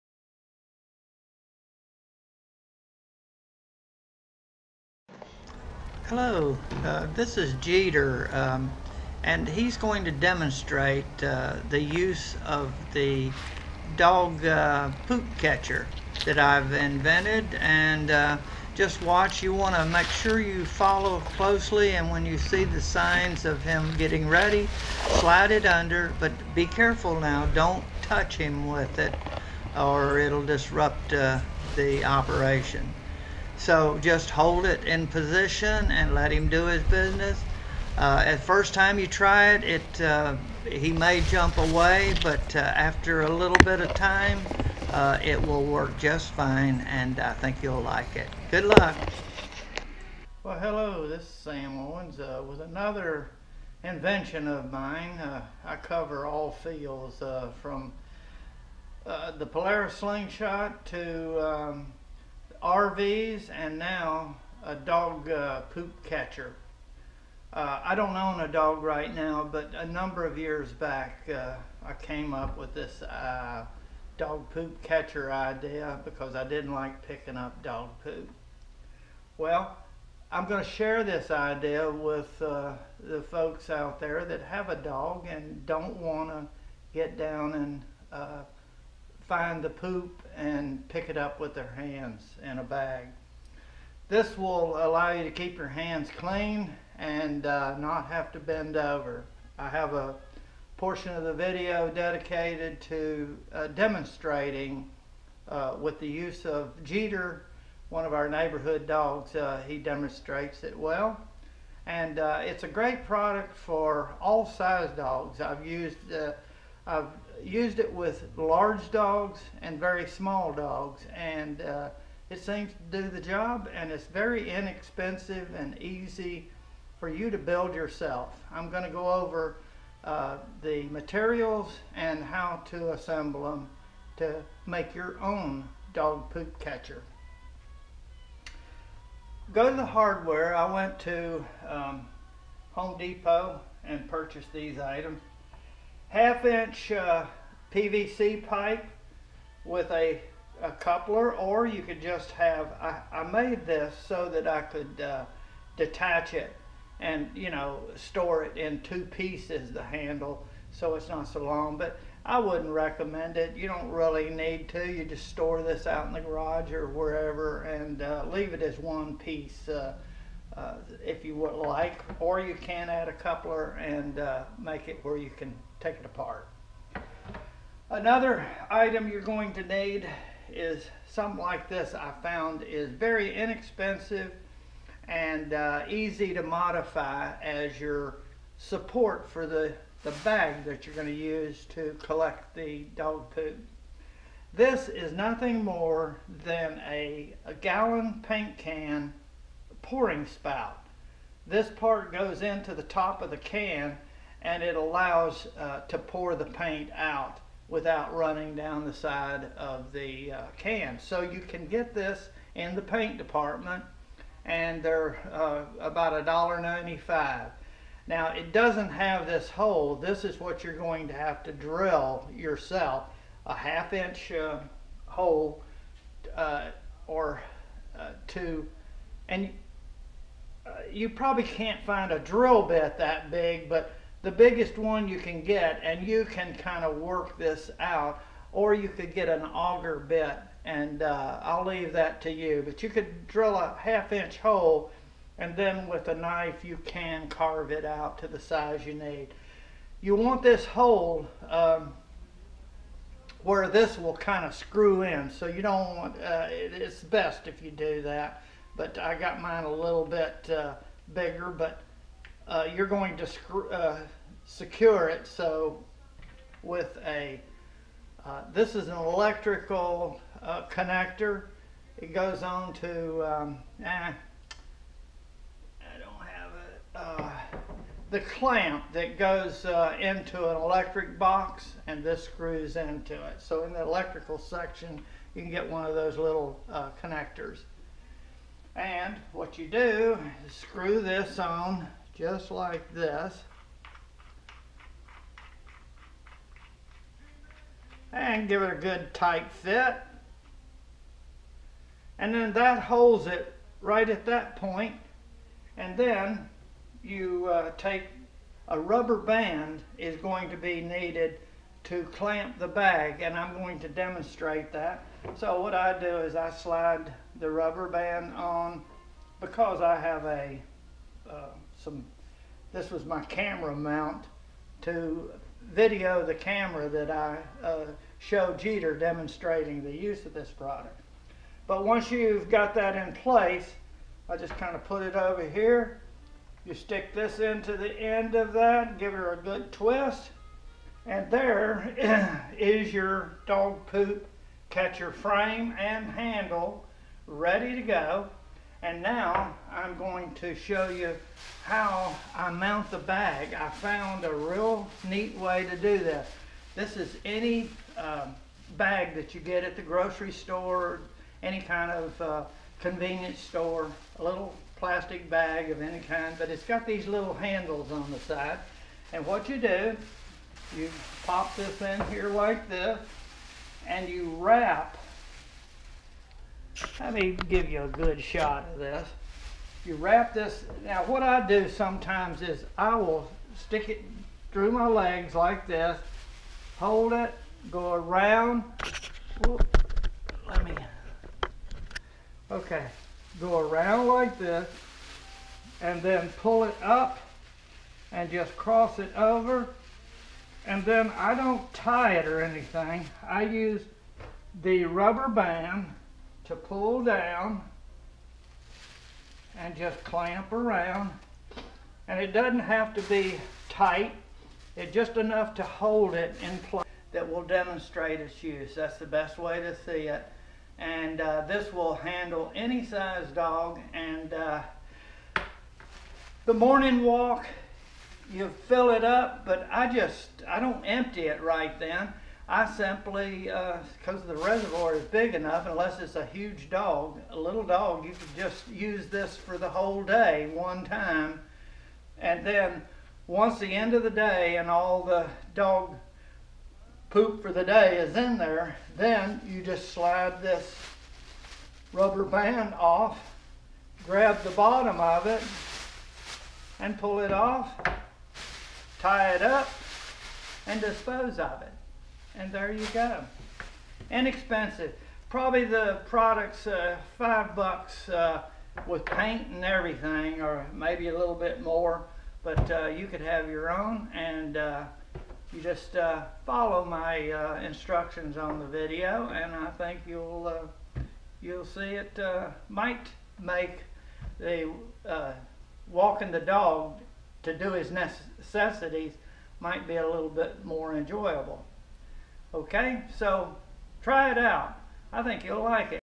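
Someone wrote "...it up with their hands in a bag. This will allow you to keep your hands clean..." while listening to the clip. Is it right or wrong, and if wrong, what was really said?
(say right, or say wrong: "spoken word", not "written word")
right.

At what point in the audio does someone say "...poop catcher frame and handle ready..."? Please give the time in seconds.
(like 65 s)
343 s.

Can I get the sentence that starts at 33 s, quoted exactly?
So just hold it in position and let him do his business.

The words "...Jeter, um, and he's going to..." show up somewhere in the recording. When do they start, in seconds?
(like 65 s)
7 s.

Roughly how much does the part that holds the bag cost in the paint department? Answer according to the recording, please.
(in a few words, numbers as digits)
$1.95.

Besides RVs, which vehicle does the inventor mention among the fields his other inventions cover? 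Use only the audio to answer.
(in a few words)
Polaris slingshot.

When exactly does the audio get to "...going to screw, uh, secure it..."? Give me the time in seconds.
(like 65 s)
262 s.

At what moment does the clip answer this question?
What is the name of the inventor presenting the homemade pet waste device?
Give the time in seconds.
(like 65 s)
51 s.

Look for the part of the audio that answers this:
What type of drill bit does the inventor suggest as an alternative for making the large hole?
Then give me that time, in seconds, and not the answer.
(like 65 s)
239 s.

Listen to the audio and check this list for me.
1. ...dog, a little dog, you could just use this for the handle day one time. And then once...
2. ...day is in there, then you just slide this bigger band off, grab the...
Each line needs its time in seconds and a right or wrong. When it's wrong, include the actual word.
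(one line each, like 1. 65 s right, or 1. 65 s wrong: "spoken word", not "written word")
1. 436 s wrong: "whole", not "handle"
2. 447 s wrong: "rubber", not "bigger".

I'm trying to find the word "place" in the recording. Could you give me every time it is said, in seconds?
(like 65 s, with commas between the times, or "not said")
333 s, 416 s.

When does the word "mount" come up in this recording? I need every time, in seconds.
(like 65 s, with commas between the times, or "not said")
323 s, 352 s.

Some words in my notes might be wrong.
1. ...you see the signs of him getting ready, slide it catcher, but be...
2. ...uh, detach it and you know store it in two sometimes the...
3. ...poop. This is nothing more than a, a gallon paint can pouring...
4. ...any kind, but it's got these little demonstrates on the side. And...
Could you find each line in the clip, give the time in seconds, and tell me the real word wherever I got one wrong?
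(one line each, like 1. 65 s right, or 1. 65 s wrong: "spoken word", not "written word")
1. 22 s wrong: "under", not "catcher"
2. 155 s wrong: "pieces", not "sometimes"
3. 193 s right
4. 365 s wrong: "handles", not "demonstrates".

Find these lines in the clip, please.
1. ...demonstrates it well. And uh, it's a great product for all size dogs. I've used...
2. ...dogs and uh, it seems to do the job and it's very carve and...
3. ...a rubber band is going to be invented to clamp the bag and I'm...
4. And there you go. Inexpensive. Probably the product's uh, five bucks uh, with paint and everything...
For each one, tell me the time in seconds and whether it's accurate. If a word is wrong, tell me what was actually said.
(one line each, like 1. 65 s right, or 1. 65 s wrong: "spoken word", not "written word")
1. 109 s right
2. 120 s wrong: "inexpensive", not "carve"
3. 308 s wrong: "needed", not "invented"
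4. 462 s right.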